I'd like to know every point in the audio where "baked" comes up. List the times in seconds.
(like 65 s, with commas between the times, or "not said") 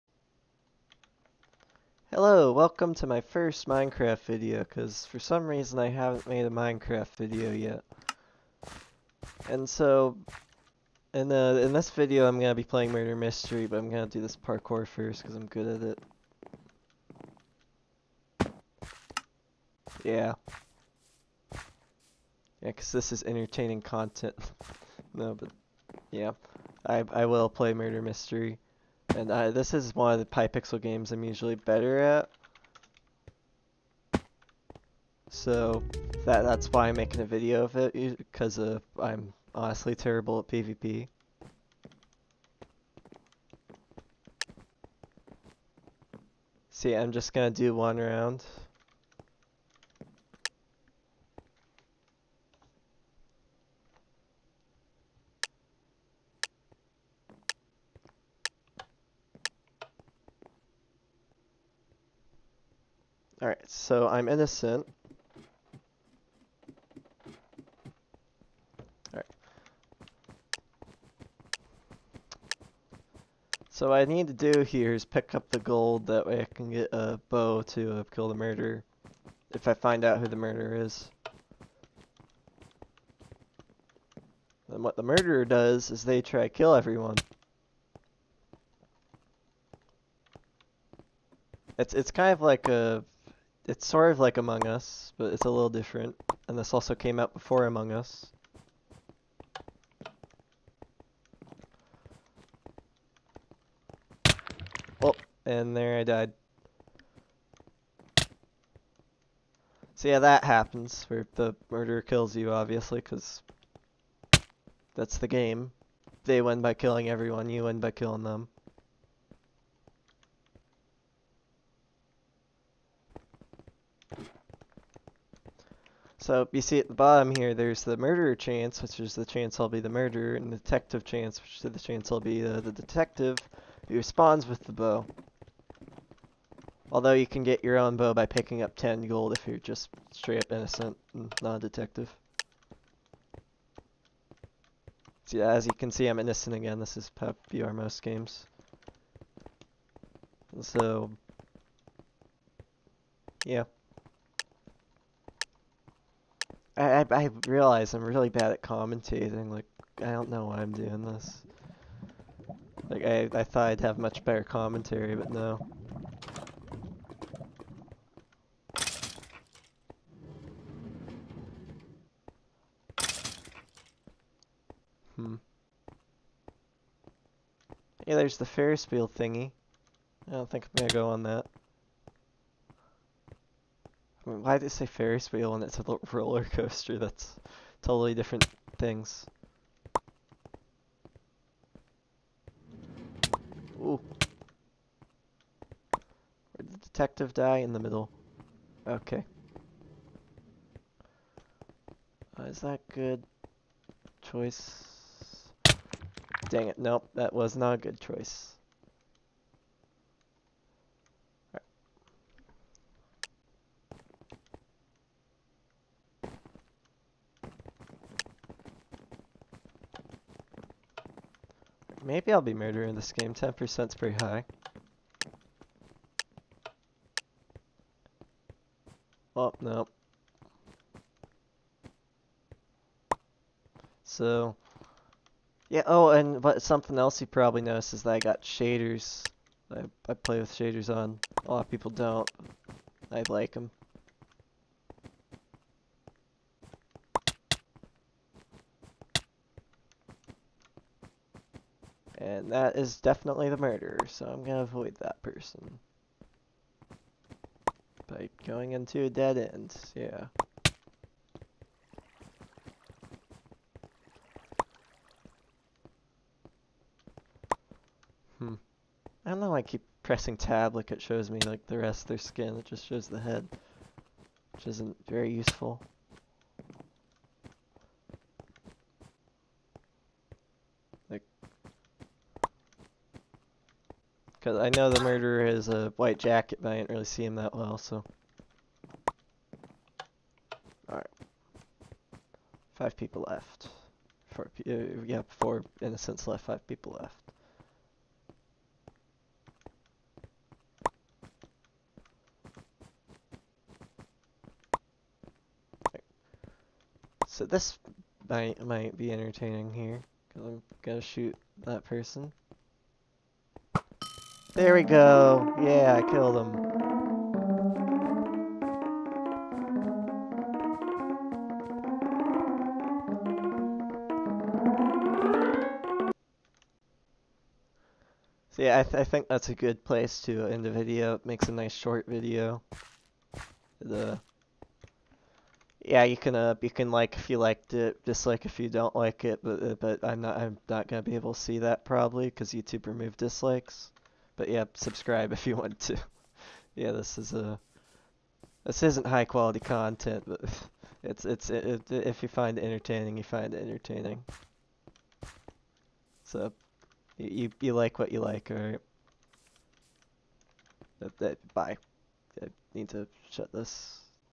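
not said.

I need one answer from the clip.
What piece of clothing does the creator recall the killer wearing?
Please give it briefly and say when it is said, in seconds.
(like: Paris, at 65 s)
white jacket, at 285 s.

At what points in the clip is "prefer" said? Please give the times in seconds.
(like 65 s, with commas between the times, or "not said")
not said.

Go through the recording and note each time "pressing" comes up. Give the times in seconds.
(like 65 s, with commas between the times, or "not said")
270 s.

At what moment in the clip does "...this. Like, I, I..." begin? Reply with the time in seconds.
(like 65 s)
161 s.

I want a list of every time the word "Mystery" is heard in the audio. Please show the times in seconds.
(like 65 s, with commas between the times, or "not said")
13 s, 28 s.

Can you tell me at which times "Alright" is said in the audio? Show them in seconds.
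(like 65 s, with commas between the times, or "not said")
63 s, 69 s, 290 s.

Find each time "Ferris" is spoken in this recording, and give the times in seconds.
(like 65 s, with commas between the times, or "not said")
178 s, 184 s.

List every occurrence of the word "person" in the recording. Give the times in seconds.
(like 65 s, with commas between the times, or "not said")
255 s, 311 s.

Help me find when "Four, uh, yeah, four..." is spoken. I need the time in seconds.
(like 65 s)
294 s.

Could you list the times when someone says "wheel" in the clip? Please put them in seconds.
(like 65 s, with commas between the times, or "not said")
178 s, 185 s.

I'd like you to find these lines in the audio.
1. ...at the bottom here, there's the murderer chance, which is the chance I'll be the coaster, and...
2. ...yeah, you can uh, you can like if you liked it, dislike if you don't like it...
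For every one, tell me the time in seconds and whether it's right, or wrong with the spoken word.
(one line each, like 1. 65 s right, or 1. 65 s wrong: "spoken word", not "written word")
1. 126 s wrong: "murderer", not "coaster"
2. 335 s right.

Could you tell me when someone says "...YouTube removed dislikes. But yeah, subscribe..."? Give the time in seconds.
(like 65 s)
342 s.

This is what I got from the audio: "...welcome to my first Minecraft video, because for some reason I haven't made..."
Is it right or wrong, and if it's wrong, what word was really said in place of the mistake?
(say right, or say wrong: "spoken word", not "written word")
right.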